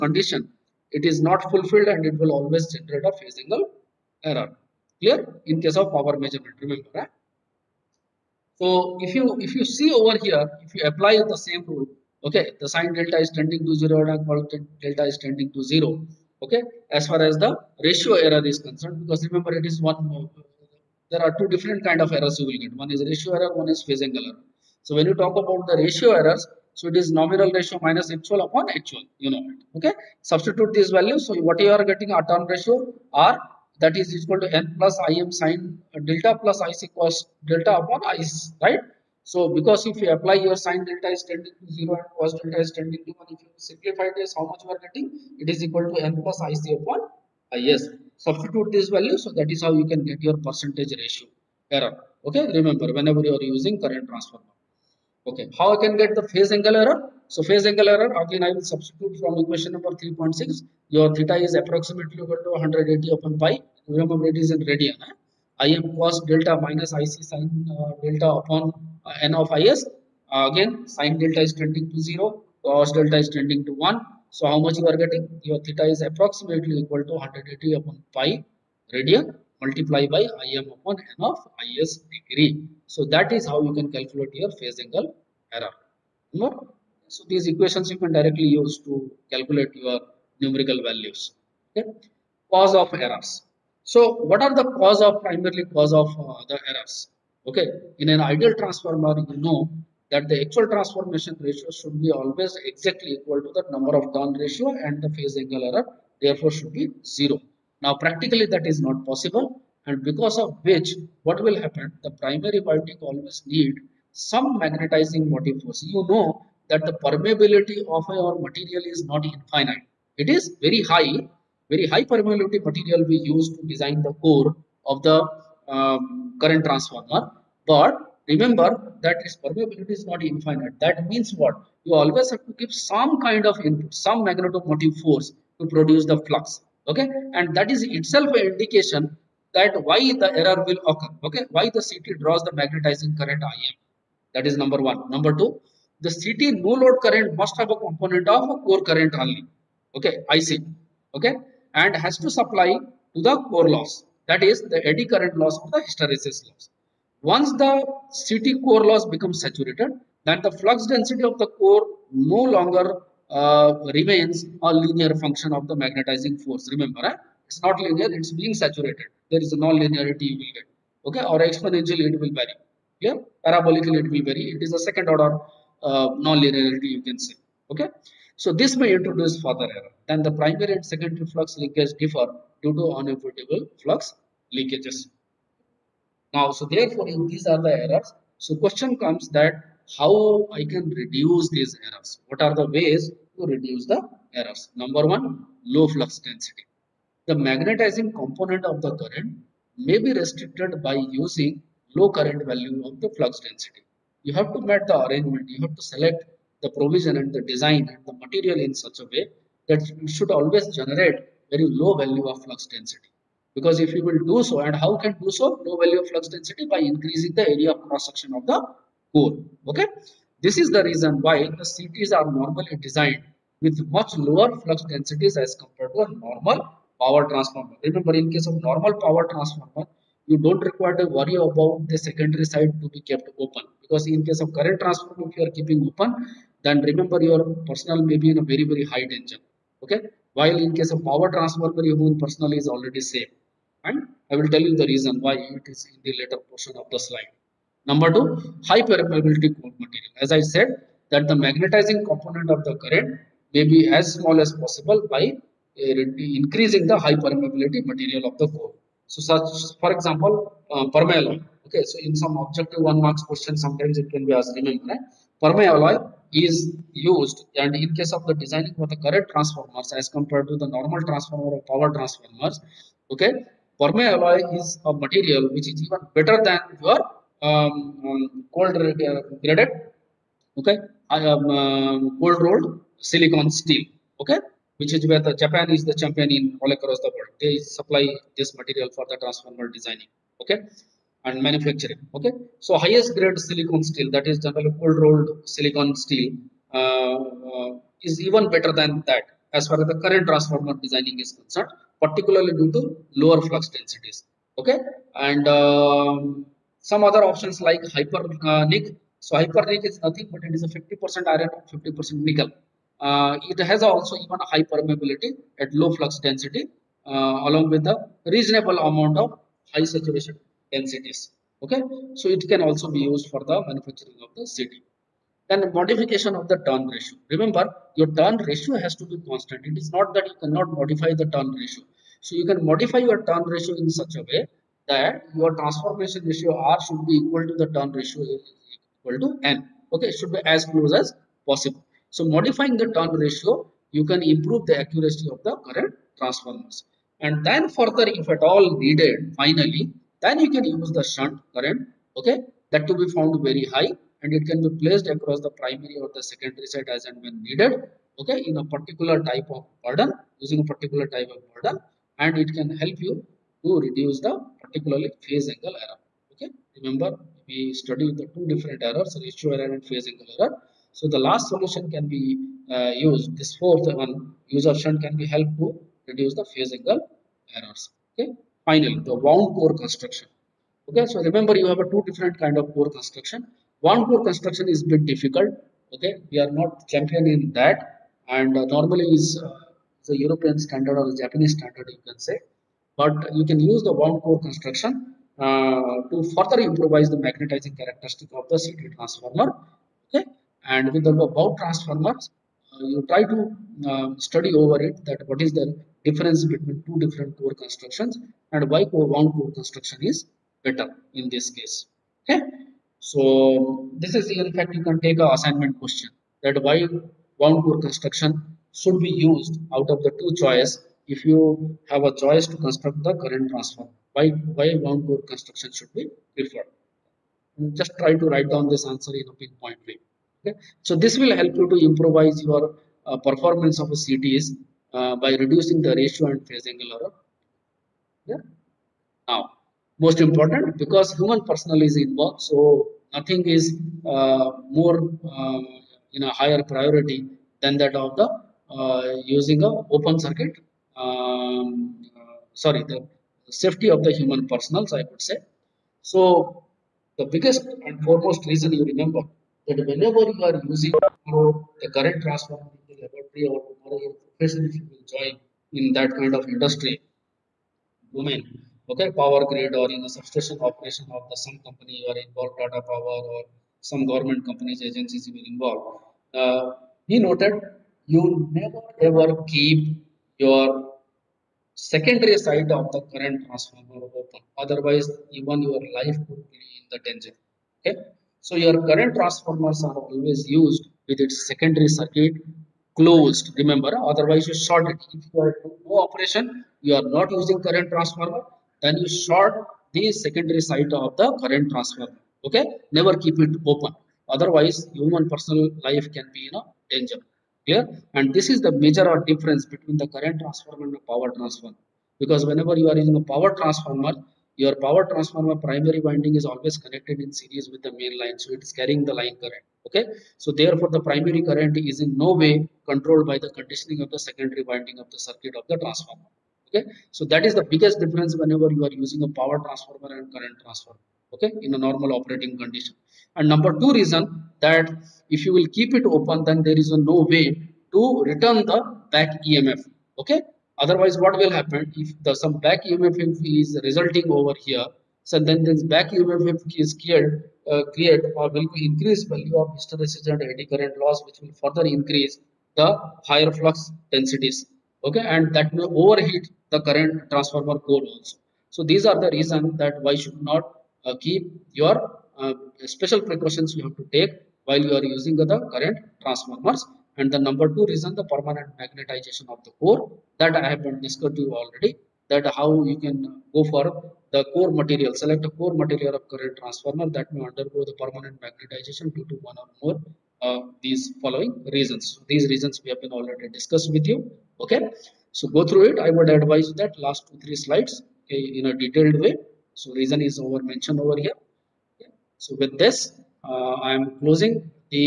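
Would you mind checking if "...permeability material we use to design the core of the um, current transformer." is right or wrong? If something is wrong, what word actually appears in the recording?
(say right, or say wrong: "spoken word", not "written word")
right.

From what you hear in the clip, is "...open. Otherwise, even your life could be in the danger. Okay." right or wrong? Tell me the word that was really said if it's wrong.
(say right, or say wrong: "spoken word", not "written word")
right.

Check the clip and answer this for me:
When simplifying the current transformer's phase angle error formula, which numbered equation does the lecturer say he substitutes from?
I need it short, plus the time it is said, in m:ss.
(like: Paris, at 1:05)
3.6, at 0:59.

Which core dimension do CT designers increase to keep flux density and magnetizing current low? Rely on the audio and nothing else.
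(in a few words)
Area of cross section.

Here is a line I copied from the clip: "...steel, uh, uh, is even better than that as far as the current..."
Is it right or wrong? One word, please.
right.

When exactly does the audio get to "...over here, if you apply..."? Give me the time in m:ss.
0:09.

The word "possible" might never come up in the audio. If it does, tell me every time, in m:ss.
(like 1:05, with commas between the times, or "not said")
1:49, 4:14, 5:41.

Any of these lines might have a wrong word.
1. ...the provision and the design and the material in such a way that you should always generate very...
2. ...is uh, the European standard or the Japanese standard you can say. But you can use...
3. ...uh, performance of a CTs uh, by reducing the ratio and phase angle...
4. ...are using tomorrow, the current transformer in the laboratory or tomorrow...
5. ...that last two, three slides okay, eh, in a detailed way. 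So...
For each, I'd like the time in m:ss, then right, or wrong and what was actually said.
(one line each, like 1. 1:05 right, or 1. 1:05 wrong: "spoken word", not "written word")
1. 3:26 right
2. 6:29 right
3. 7:13 right
4. 7:40 right
5. 9:46 right.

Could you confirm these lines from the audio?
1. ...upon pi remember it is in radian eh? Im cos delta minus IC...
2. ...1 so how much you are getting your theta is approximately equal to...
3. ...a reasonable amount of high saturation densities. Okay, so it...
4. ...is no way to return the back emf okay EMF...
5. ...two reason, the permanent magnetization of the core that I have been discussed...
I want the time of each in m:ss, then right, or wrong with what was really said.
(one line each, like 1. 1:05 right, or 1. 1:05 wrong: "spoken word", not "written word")
1. 1:03 right
2. 1:13 right
3. 5:17 right
4. 8:56 wrong: "Otherwise", not "EMF"
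5. 9:27 right.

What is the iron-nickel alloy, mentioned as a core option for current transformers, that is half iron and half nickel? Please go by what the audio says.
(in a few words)
Hypernik.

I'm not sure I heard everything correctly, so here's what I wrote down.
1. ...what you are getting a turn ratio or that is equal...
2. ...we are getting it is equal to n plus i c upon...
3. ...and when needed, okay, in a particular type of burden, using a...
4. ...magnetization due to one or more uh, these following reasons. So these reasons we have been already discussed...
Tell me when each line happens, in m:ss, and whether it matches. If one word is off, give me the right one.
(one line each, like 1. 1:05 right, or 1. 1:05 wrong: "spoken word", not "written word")
1. 0:31 right
2. 0:44 right
3. 5:57 right
4. 9:38 right.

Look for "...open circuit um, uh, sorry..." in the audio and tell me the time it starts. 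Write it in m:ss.
7:29.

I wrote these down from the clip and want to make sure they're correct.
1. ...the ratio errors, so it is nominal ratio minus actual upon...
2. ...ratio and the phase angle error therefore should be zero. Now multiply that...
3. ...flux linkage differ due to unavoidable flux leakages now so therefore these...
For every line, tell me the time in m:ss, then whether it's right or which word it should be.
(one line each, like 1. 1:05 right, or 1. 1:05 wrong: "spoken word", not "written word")
1. 0:25 right
2. 1:44 wrong: "practically", not "multiply"
3. 3:01 right.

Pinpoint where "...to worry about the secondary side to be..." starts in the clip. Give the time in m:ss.
3:50.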